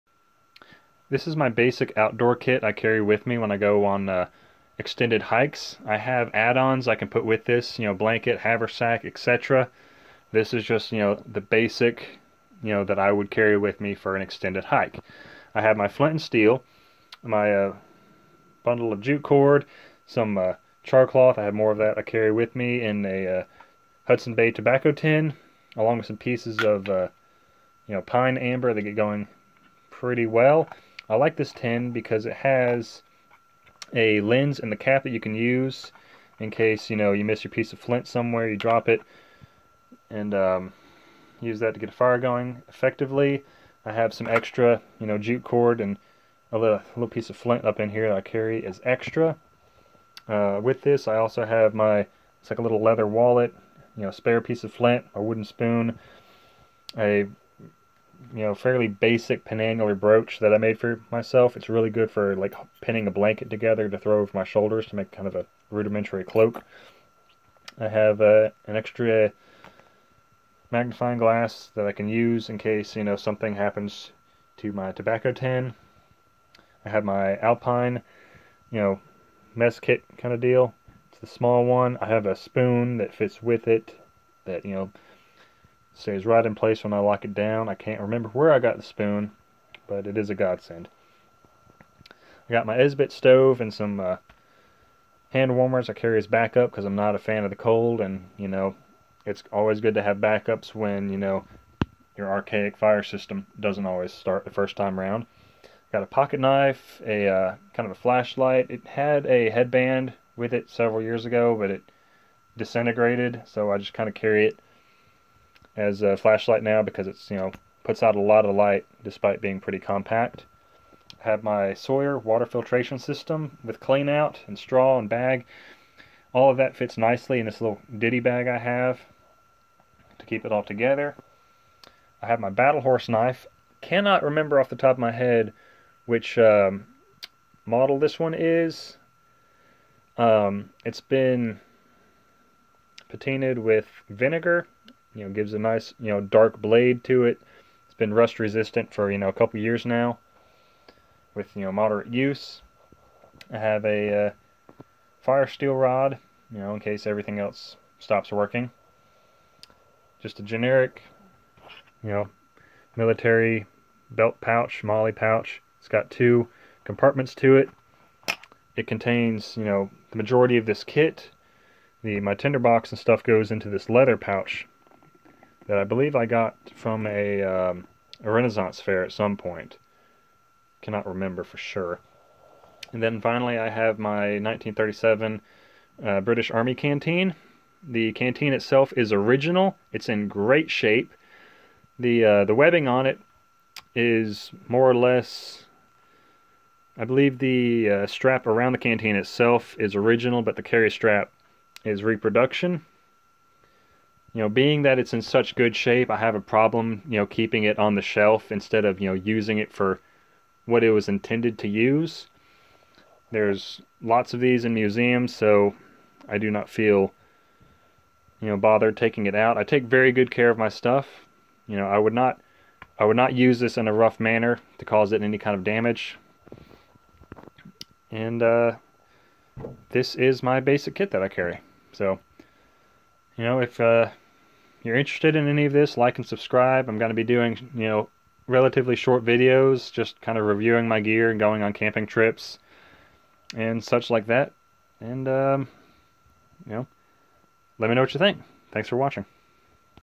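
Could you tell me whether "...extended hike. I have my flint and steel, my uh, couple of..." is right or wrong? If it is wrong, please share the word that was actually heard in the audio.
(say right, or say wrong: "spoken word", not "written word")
wrong: "bundle", not "couple".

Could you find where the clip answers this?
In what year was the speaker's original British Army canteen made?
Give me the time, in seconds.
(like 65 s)
184 s.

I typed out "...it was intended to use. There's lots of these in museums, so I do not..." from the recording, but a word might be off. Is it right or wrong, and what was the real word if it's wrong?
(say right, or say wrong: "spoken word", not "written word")
right.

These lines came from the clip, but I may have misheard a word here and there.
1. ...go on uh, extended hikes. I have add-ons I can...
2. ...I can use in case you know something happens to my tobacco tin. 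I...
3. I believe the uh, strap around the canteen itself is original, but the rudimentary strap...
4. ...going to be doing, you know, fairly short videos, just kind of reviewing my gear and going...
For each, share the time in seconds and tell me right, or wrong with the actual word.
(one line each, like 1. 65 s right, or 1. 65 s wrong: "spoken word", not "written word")
1. 3 s right
2. 71 s right
3. 196 s wrong: "carry", not "rudimentary"
4. 236 s wrong: "relatively", not "fairly".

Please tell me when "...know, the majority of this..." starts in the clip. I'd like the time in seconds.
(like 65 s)
169 s.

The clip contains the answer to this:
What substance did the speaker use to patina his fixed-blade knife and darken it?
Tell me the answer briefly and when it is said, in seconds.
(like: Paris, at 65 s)
vinegar, at 144 s.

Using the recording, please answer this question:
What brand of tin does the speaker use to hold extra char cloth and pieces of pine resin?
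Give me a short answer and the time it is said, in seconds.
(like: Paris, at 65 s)
Hudson Bay, at 24 s.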